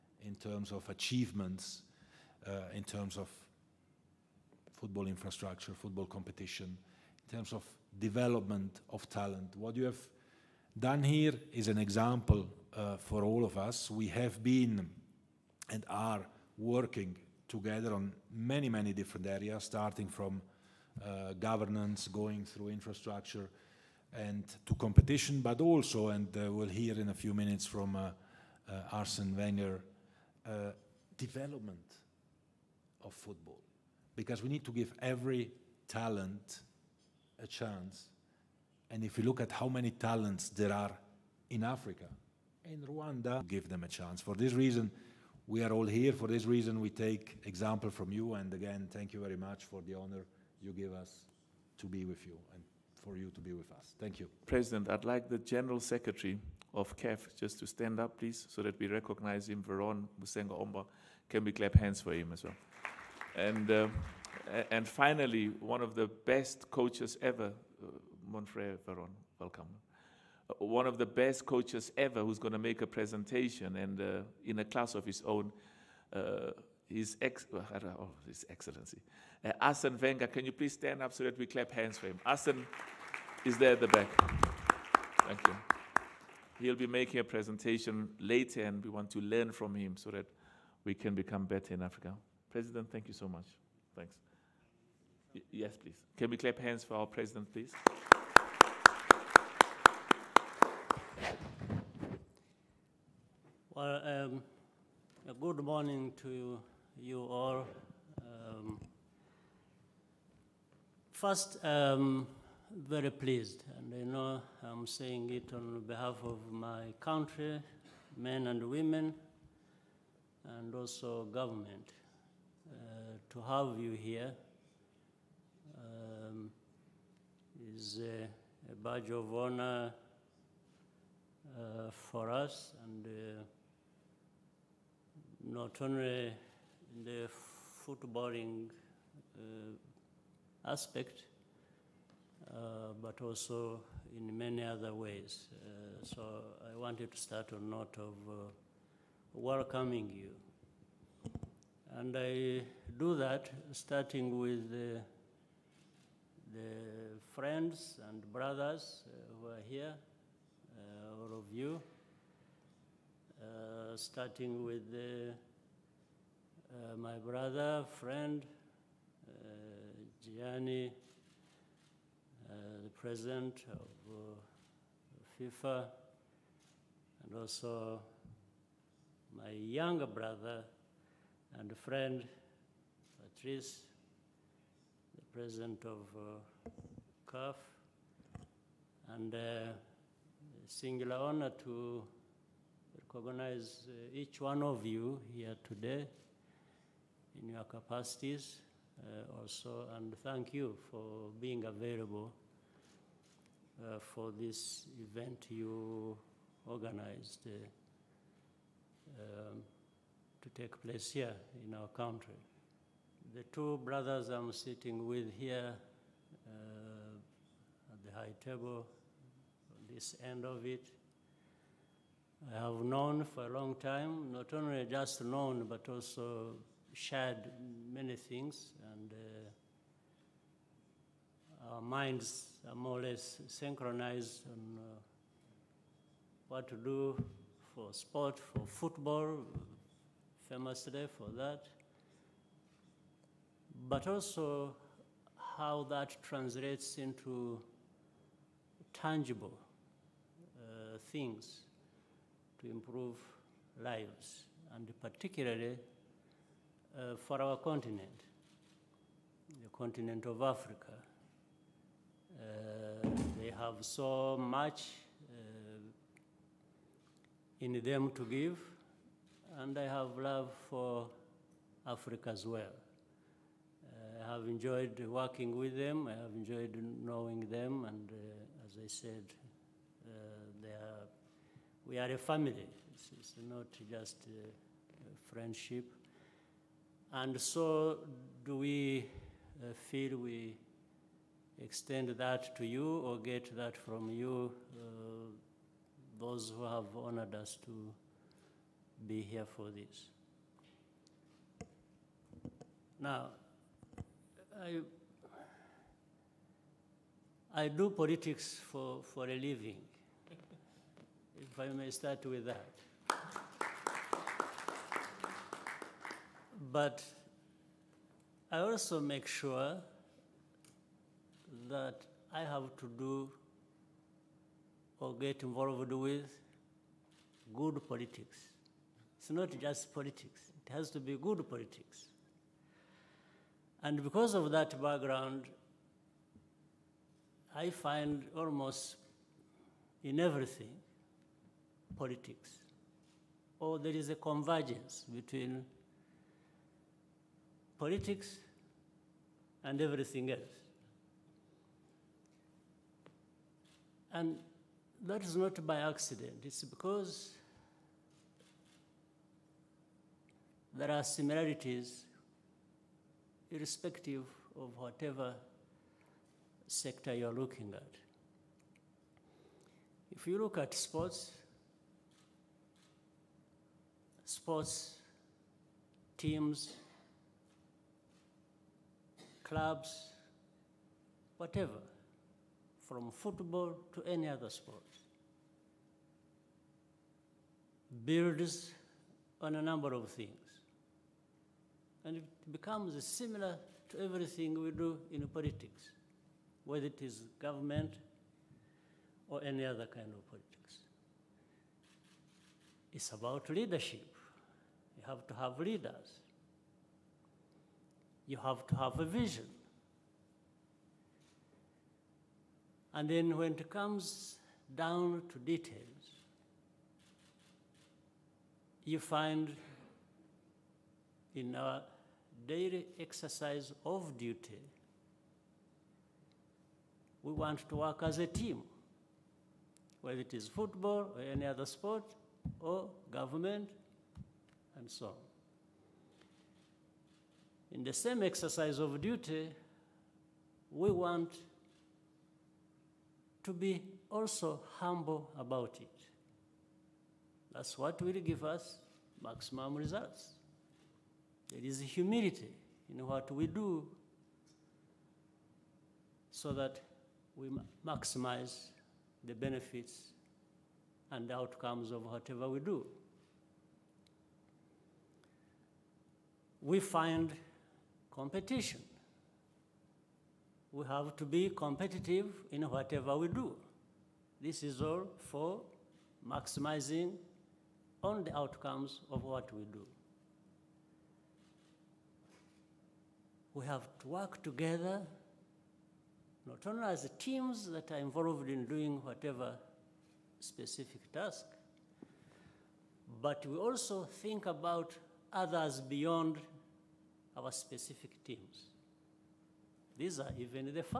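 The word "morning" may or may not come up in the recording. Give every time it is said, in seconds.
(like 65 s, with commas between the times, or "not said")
105 s.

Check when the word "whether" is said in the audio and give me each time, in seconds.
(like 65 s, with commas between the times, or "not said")
396 s, 430 s.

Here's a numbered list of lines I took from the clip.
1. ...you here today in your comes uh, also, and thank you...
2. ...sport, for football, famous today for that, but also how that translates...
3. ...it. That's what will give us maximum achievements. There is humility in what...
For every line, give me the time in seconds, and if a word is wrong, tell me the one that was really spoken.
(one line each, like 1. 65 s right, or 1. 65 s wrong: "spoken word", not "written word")
1. 194 s wrong: "capacities", not "comes"
2. 237 s right
3. 445 s wrong: "results", not "achievements".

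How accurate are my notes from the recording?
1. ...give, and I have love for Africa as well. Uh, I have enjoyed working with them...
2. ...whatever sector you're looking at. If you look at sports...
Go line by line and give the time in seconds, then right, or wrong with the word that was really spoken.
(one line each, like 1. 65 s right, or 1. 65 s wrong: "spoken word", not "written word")
1. 268 s right
2. 364 s right.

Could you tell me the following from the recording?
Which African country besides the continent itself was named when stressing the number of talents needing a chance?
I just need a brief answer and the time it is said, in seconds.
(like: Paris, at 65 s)
Rwanda, at 42 s.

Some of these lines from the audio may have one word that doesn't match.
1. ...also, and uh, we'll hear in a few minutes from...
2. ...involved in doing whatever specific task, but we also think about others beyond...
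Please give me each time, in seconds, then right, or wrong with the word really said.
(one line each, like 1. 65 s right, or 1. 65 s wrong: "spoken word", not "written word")
1. 25 s right
2. 487 s right.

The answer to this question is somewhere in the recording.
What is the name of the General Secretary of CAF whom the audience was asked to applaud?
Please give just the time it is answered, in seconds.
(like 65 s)
59 s.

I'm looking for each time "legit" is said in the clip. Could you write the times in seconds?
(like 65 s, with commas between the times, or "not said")
not said.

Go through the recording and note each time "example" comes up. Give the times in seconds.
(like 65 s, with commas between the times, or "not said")
11 s, 47 s.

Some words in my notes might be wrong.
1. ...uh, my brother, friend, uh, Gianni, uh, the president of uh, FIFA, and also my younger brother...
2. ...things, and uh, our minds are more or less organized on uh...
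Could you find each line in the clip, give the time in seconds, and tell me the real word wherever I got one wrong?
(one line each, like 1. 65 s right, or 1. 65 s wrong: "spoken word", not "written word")
1. 166 s right
2. 228 s wrong: "synchronized", not "organized".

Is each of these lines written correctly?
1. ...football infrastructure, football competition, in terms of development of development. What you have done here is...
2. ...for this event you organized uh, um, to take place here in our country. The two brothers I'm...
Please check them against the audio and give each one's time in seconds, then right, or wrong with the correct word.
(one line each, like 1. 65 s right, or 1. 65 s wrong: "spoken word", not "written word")
1. 4 s wrong: "talent", not "development"
2. 204 s right.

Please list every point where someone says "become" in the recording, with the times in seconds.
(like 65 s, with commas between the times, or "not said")
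91 s, 392 s.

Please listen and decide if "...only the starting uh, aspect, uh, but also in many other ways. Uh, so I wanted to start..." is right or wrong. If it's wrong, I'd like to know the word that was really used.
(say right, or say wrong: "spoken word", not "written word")
wrong: "footballing", not "starting".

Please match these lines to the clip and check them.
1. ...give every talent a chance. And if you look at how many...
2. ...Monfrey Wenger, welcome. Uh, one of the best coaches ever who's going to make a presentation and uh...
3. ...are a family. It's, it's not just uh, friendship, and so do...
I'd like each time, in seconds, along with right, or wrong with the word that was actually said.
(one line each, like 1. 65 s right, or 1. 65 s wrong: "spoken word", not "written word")
1. 34 s right
2. 68 s wrong: "Veron", not "Wenger"
3. 281 s right.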